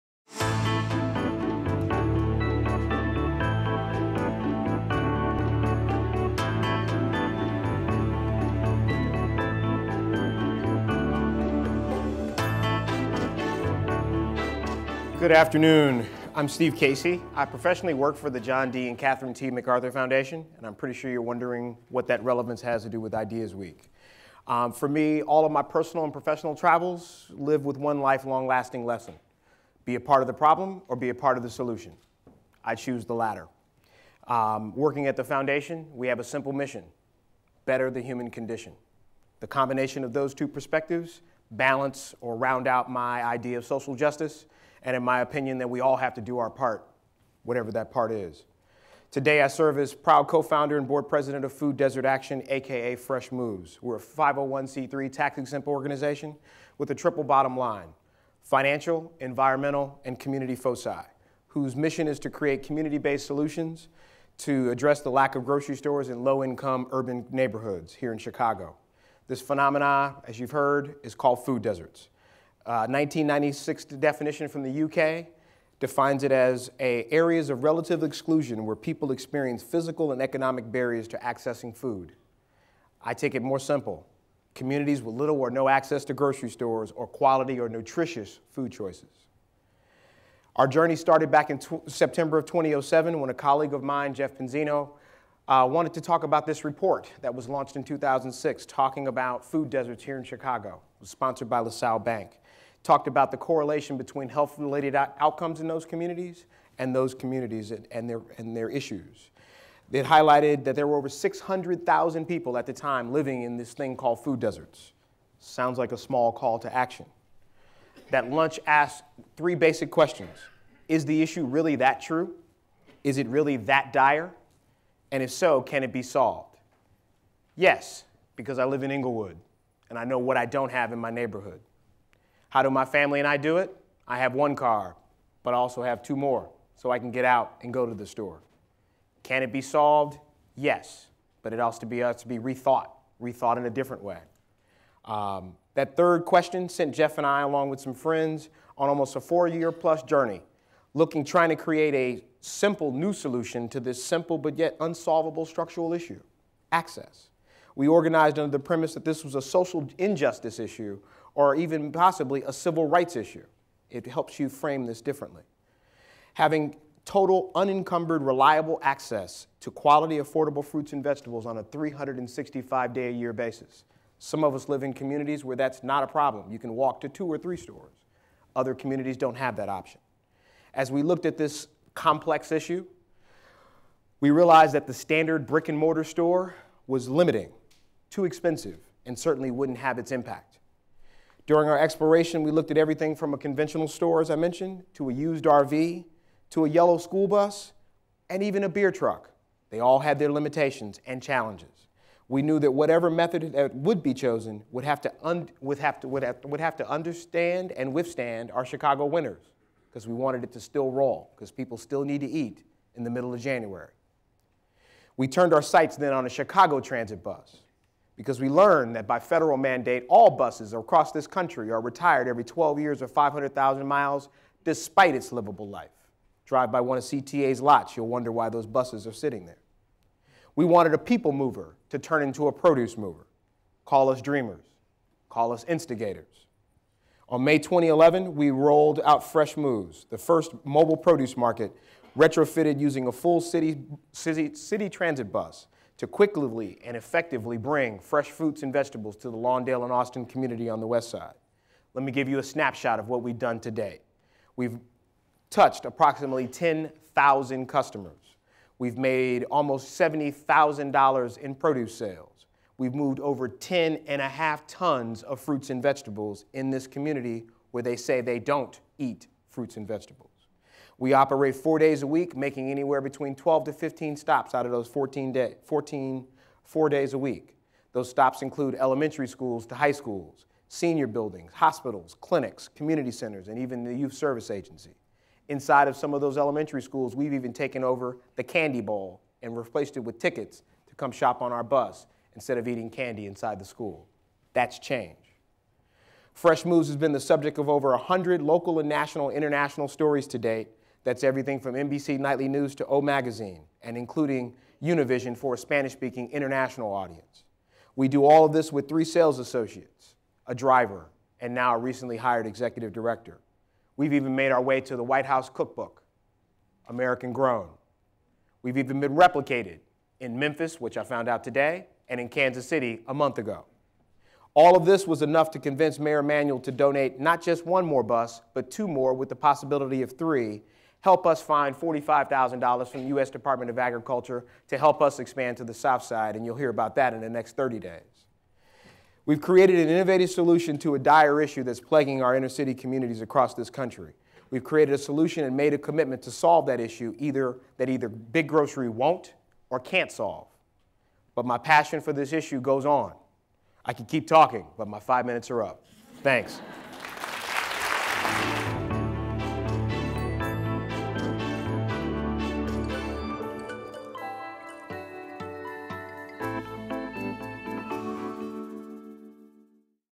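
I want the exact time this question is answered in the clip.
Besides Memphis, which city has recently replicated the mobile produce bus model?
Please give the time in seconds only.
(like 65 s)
322 s.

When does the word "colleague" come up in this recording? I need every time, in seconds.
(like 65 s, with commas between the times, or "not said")
93 s.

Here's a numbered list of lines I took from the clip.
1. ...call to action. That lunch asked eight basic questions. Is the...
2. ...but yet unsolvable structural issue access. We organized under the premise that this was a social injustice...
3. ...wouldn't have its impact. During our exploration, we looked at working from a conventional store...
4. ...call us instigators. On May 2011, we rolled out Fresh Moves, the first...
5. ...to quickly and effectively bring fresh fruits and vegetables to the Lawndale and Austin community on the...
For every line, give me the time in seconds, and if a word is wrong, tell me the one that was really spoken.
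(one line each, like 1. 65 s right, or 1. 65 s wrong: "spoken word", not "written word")
1. 116 s wrong: "three", not "eight"
2. 154 s right
3. 189 s wrong: "everything", not "working"
4. 235 s right
5. 246 s right.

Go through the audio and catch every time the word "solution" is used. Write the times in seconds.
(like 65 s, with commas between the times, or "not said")
31 s, 63 s, 153 s, 340 s, 344 s.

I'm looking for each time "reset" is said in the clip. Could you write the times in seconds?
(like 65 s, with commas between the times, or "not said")
not said.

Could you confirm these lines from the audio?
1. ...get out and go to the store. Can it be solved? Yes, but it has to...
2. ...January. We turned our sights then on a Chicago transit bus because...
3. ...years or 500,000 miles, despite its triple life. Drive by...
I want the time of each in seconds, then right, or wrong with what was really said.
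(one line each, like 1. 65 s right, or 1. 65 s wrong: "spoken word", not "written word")
1. 137 s right
2. 213 s right
3. 222 s wrong: "livable", not "triple".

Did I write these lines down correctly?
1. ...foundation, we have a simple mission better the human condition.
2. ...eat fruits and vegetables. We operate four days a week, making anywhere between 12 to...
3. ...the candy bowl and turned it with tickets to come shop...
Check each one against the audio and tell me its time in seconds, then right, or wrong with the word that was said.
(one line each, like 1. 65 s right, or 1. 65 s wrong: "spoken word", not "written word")
1. 35 s right
2. 268 s right
3. 288 s wrong: "replaced", not "turned".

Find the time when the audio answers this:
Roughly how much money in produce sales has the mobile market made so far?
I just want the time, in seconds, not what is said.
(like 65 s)
259 s.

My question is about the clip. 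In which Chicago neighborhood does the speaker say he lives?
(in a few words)
Englewood.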